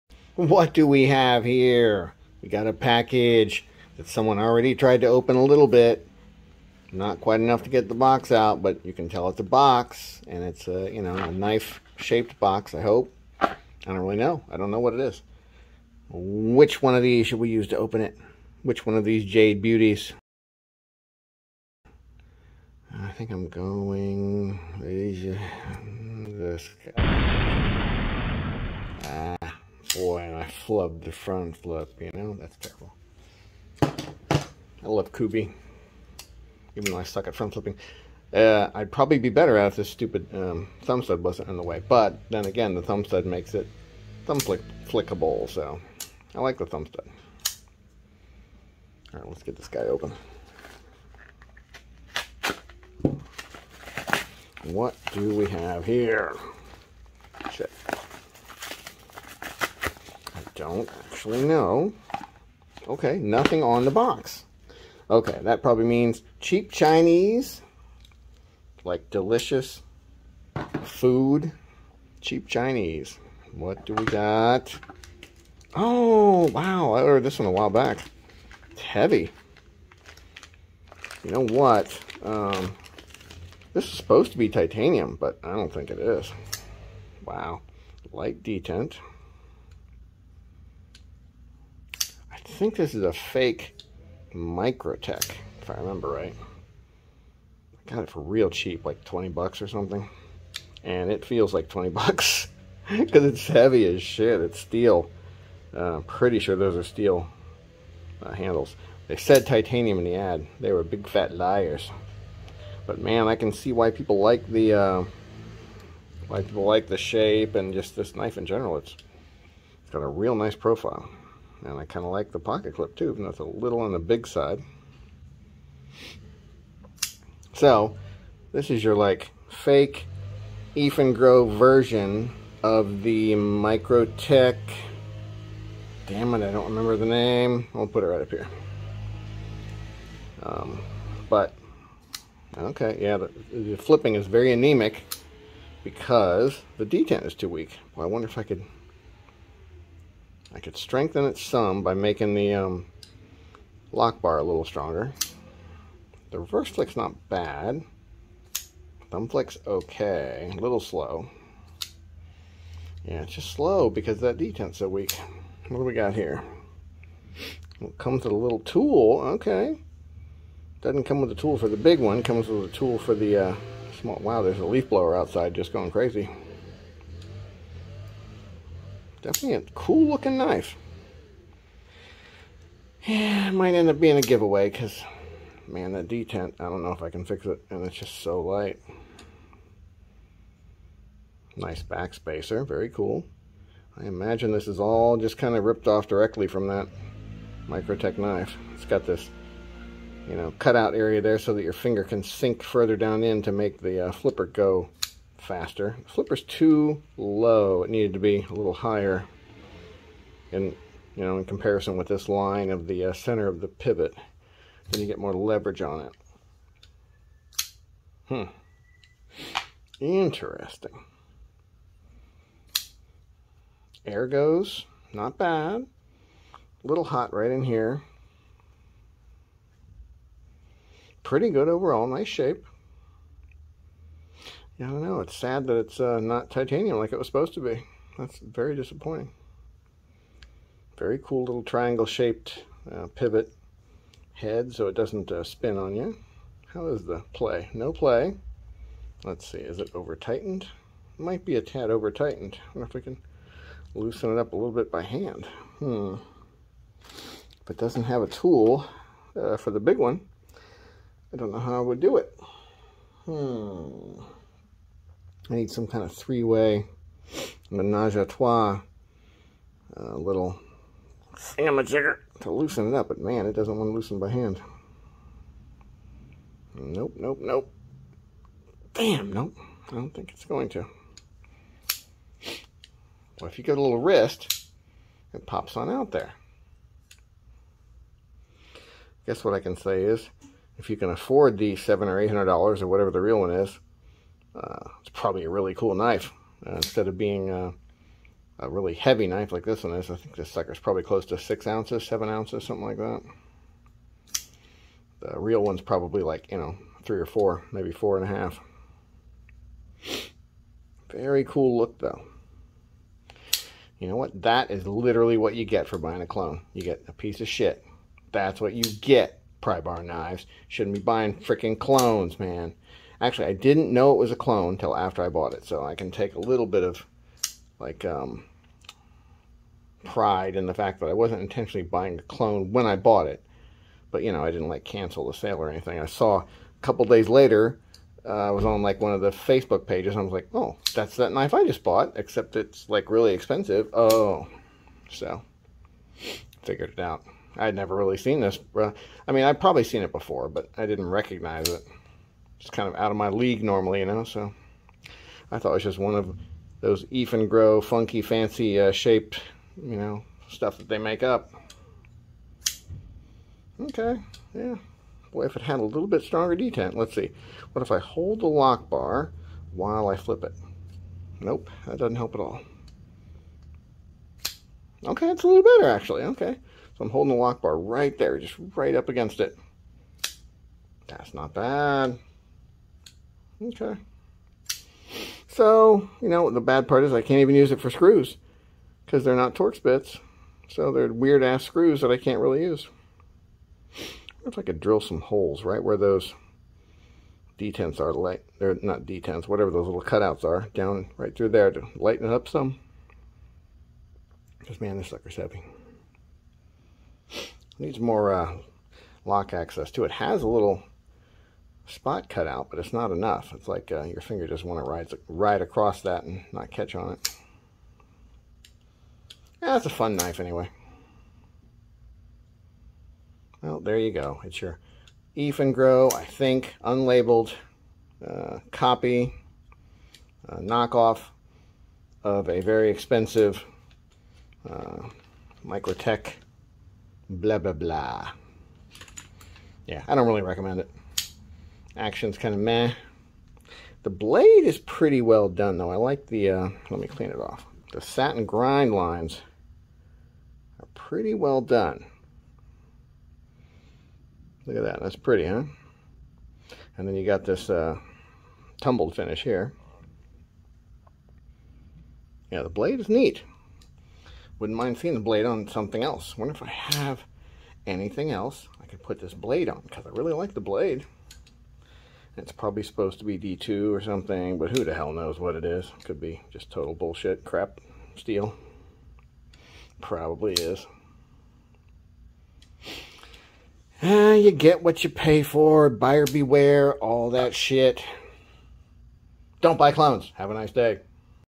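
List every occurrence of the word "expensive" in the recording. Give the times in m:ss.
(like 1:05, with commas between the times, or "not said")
5:43, 7:12.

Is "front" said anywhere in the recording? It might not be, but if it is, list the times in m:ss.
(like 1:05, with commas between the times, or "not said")
0:31, 0:37.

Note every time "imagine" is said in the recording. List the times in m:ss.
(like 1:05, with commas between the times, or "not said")
3:14.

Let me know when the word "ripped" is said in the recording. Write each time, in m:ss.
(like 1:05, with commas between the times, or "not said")
3:15.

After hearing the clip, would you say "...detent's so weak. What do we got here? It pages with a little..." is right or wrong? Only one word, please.
wrong.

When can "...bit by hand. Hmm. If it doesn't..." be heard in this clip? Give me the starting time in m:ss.
4:14.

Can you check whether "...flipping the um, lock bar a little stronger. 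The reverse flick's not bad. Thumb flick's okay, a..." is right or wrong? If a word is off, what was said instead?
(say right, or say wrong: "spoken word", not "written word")
wrong: "making", not "flipping".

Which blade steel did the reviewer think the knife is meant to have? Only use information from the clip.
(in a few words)
D2.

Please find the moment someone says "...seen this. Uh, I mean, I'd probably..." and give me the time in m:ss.
5:48.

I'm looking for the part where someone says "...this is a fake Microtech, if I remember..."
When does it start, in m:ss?
1:32.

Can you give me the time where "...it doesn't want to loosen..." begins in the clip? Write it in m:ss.
4:33.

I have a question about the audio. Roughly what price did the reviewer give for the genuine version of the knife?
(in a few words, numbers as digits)
700 or 800 dollars.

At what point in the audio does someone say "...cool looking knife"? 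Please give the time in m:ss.
2:59.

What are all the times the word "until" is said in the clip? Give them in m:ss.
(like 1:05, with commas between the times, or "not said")
5:24.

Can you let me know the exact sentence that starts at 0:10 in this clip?
And it's a, you know, a knife-shaped box, I hope.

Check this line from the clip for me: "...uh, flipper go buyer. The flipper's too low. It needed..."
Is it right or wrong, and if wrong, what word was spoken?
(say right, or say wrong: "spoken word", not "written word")
wrong: "faster", not "buyer".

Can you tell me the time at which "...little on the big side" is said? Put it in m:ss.
2:03.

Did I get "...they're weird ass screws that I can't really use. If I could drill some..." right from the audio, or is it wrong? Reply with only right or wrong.
right.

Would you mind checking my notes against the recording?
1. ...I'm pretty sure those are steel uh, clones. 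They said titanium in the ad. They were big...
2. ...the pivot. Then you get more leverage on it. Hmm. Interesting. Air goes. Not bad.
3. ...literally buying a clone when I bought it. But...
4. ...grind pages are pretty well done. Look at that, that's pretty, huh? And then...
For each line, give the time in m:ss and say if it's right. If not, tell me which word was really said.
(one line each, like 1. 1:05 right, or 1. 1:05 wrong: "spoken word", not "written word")
1. 1:45 wrong: "handles", not "clones"
2. 3:33 right
3. 5:31 wrong: "intentionally", not "literally"
4. 7:28 wrong: "lines", not "pages".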